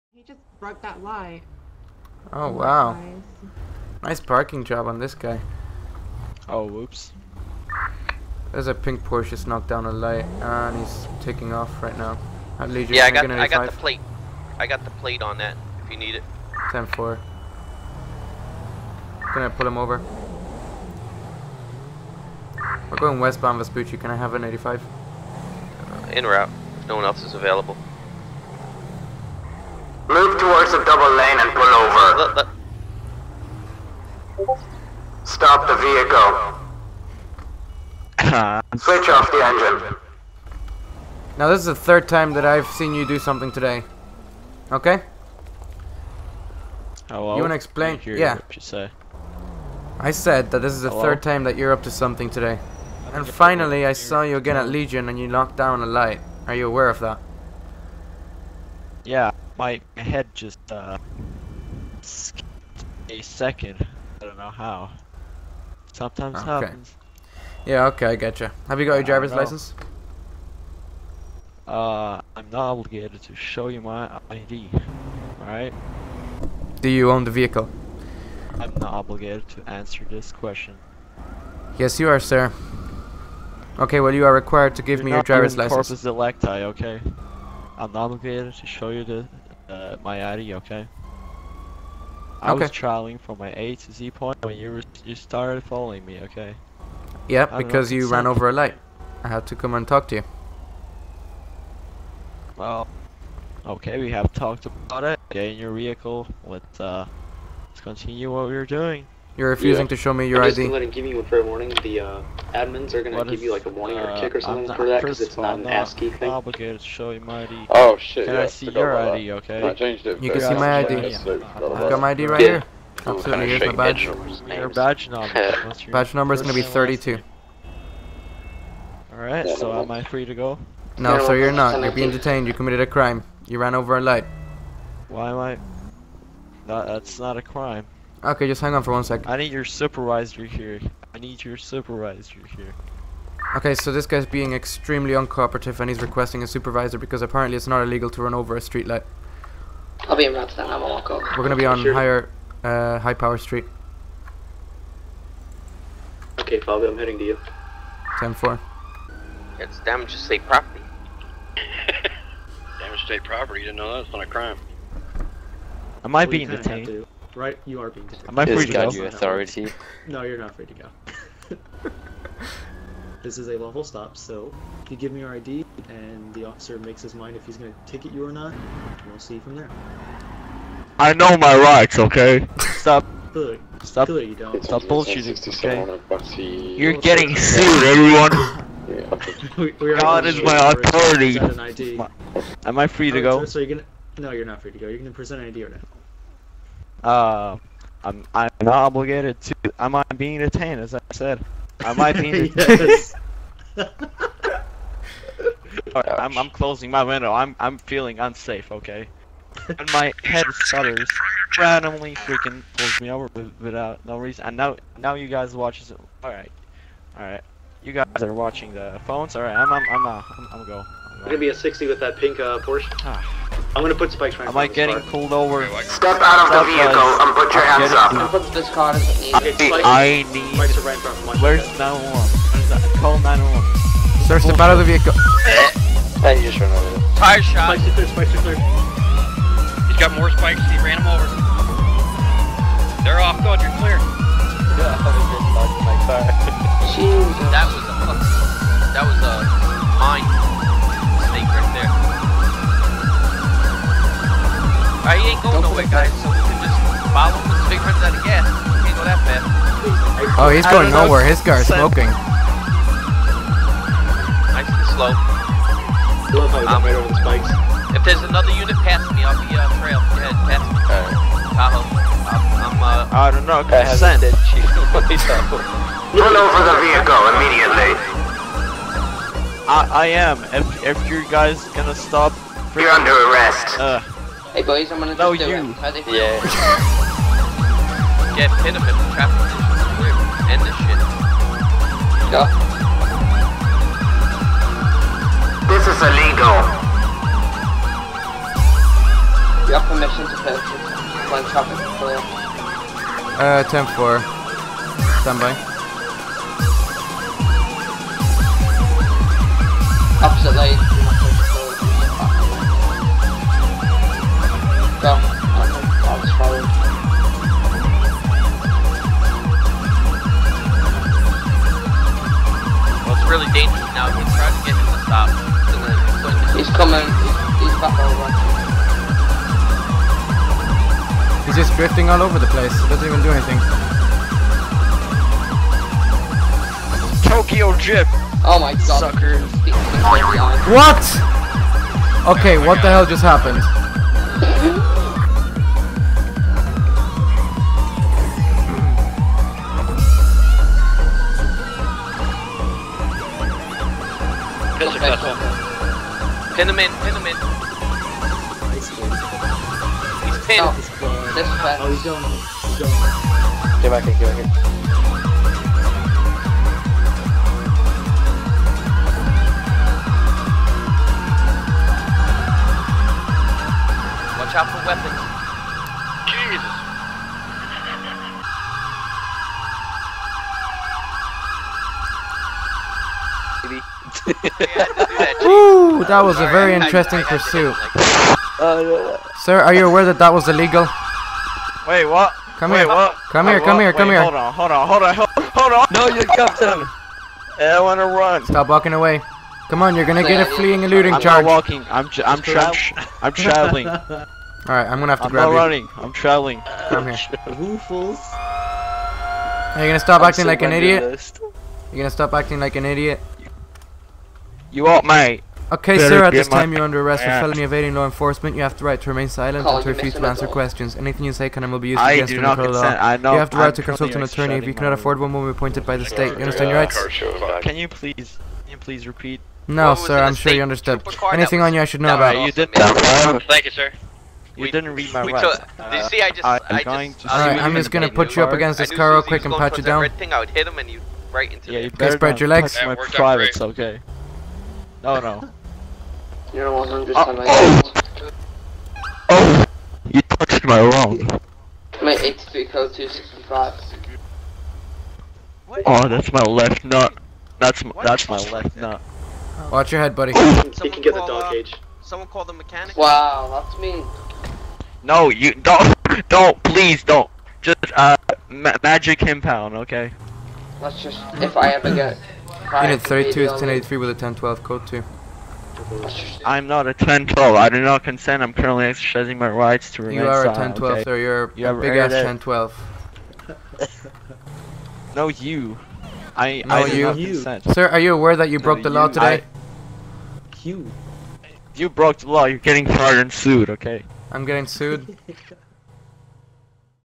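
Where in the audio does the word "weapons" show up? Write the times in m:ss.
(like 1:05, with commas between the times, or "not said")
6:24.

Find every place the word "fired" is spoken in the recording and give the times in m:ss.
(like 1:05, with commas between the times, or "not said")
8:12.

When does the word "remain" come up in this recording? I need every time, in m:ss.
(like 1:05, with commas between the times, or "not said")
6:59, 8:00.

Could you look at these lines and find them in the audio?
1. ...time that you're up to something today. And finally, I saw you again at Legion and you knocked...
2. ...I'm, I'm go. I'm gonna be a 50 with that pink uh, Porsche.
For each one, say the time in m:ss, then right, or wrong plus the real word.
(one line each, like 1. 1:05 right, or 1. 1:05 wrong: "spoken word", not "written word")
1. 0:51 right
2. 3:40 wrong: "60", not "50".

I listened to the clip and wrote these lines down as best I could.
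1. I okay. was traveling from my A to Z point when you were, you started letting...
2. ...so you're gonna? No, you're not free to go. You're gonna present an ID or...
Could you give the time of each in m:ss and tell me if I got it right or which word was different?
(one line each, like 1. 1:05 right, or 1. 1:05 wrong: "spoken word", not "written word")
1. 1:32 wrong: "following", not "letting"
2. 3:13 right.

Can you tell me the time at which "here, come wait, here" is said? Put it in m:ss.
6:33.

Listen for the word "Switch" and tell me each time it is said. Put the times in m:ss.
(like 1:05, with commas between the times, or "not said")
0:38.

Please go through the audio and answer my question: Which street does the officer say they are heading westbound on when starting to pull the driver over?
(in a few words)
Vespucci.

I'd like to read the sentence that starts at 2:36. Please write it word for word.
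Okay, Fabio, I'm heading to you.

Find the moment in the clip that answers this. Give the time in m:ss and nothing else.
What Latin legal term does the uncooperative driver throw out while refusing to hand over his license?
1:25.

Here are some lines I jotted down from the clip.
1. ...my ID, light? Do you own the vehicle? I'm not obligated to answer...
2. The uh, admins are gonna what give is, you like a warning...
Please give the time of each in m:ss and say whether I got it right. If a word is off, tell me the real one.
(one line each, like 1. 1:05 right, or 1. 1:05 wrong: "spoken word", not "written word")
1. 1:13 wrong: "alright", not "light"
2. 1:51 right.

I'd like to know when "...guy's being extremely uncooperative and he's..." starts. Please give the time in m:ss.
2:24.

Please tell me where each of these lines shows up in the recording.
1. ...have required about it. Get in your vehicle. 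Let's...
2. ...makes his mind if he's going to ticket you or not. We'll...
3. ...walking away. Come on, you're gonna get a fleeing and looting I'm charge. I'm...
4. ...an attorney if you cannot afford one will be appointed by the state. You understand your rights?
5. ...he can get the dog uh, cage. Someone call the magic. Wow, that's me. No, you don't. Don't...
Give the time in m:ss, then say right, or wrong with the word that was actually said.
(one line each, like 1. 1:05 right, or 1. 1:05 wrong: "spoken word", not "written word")
1. 1:44 wrong: "talked", not "required"
2. 2:56 right
3. 6:38 right
4. 7:04 right
5. 7:40 wrong: "mechanic", not "magic".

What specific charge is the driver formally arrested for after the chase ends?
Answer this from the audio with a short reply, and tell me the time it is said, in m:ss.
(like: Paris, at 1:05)
Felony evading law enforcement, at 6:57.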